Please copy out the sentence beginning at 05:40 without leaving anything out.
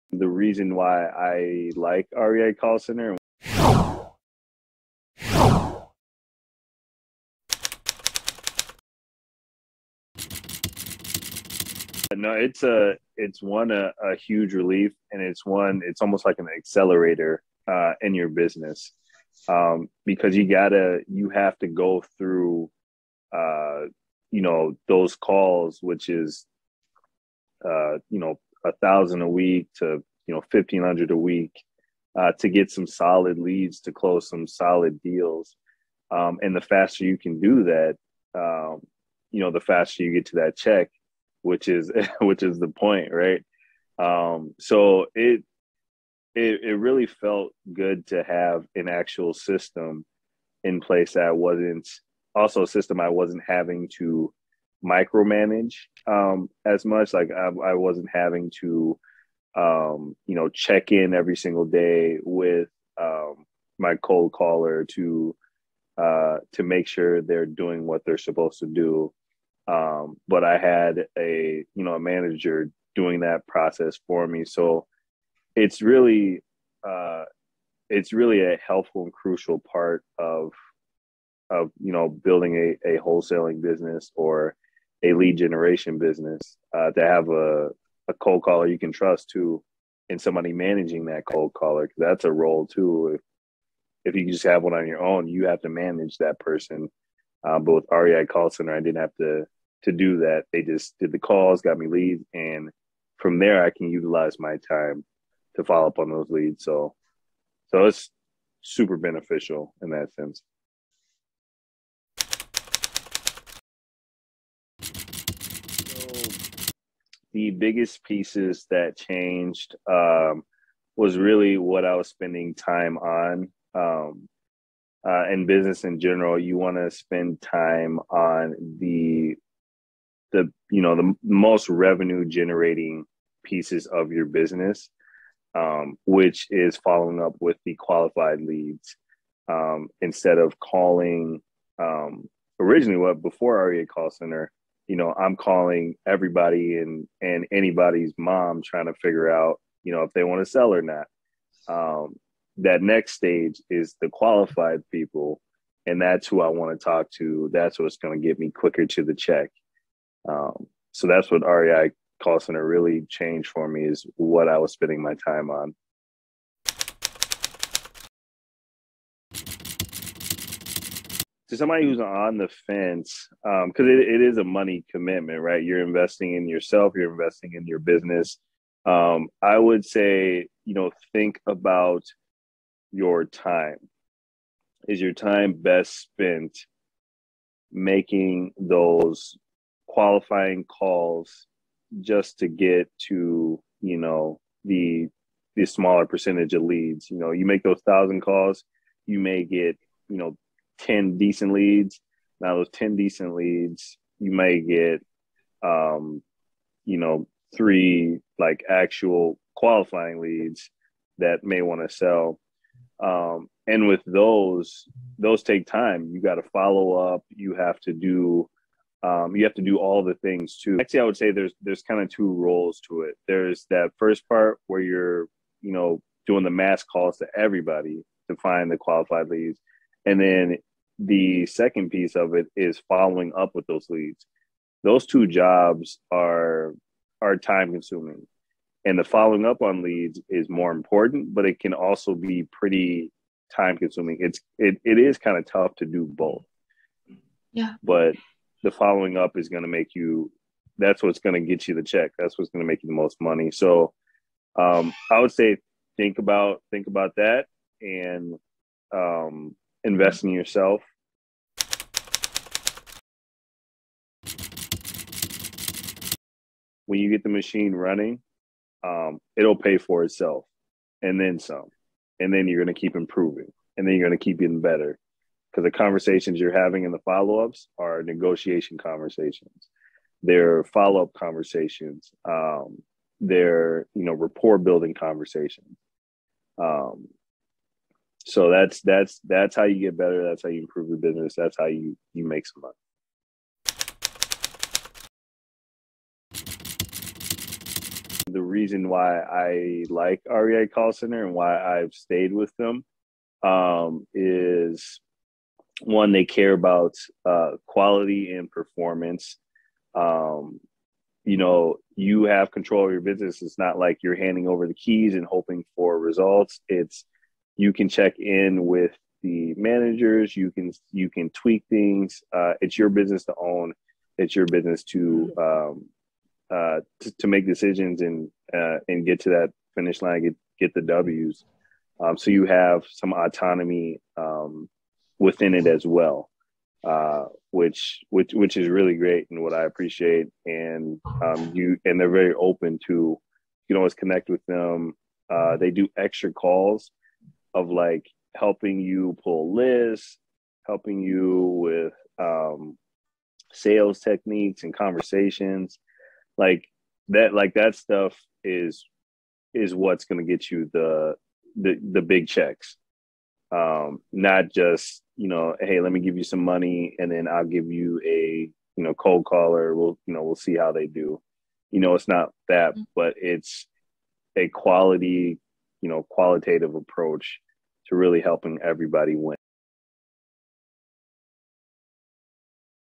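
And um, you and they're very open to you can always connect with them.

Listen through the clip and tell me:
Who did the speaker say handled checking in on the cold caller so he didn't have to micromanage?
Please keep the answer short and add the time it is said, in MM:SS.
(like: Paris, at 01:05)
a manager, at 01:11.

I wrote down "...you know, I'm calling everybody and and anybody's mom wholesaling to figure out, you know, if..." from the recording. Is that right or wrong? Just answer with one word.
wrong.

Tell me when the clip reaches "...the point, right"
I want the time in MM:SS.
00:42.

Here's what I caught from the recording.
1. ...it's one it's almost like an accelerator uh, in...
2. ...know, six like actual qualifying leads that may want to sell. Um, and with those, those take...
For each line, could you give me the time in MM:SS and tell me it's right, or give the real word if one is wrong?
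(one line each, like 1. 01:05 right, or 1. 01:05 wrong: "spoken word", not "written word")
1. 00:15 right
2. 03:26 wrong: "three", not "six".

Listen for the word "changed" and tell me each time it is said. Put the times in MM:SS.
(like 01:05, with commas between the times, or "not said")
01:58, 02:43.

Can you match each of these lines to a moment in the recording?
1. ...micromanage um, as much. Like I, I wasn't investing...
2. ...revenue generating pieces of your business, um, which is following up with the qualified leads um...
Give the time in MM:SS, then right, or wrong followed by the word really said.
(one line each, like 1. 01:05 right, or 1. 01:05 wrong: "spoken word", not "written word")
1. 00:54 wrong: "having", not "investing"
2. 02:11 right.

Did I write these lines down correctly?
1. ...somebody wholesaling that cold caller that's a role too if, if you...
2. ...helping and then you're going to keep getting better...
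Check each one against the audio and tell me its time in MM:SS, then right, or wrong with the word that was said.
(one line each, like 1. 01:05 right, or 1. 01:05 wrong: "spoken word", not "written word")
1. 01:30 wrong: "managing", not "wholesaling"
2. 04:32 wrong: "improving", not "helping".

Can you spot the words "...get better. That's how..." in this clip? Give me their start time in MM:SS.
04:49.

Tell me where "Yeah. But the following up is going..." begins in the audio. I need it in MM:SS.
04:07.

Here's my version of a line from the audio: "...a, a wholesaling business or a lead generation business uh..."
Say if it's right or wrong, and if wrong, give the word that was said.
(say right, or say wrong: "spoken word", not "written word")
right.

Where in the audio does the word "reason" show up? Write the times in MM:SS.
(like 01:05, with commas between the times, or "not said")
00:00, 04:58.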